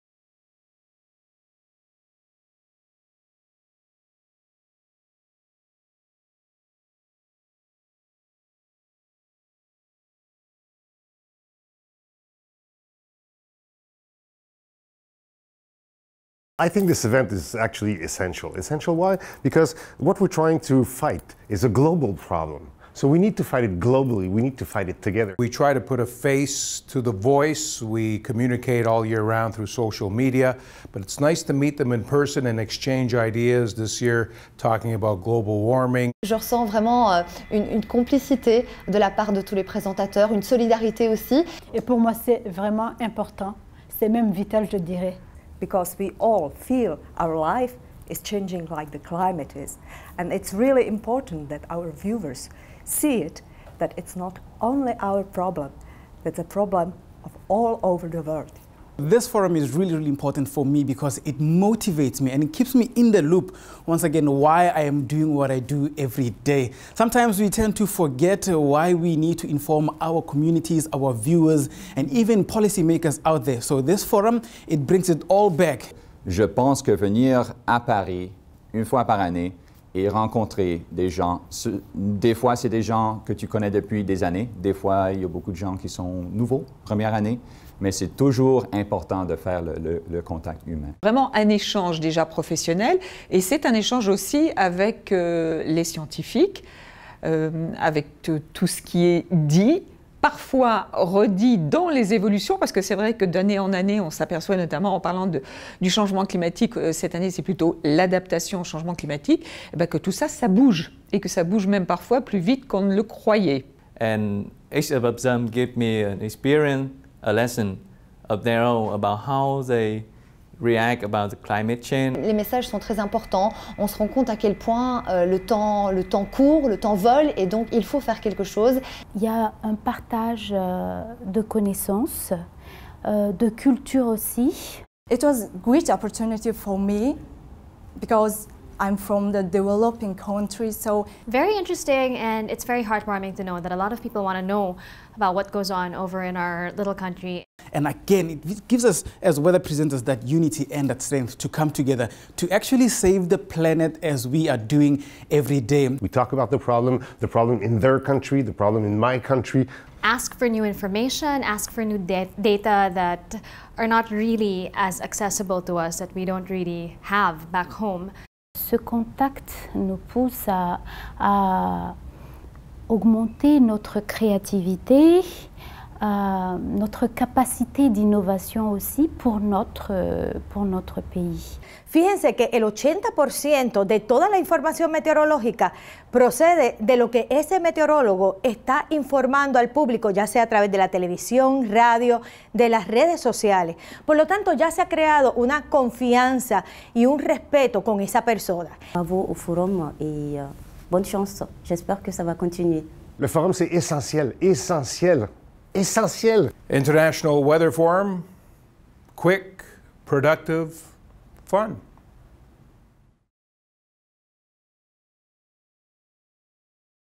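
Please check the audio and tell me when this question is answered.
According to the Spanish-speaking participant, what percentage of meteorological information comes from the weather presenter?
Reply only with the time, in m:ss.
3:02.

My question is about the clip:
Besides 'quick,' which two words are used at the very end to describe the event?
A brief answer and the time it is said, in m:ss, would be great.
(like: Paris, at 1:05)
productive, fun, at 3:30.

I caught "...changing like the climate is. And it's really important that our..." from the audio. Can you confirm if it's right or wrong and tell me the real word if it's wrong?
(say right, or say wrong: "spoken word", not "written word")
right.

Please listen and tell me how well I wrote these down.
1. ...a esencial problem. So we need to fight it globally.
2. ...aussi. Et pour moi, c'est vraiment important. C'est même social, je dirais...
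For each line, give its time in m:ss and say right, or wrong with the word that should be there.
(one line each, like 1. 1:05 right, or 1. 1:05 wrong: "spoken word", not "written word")
1. 0:21 wrong: "global", not "esencial"
2. 0:41 wrong: "vital", not "social".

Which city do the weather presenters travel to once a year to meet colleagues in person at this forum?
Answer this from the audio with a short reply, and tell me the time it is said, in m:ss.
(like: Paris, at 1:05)
Paris, at 1:17.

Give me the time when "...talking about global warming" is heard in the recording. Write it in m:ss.
0:34.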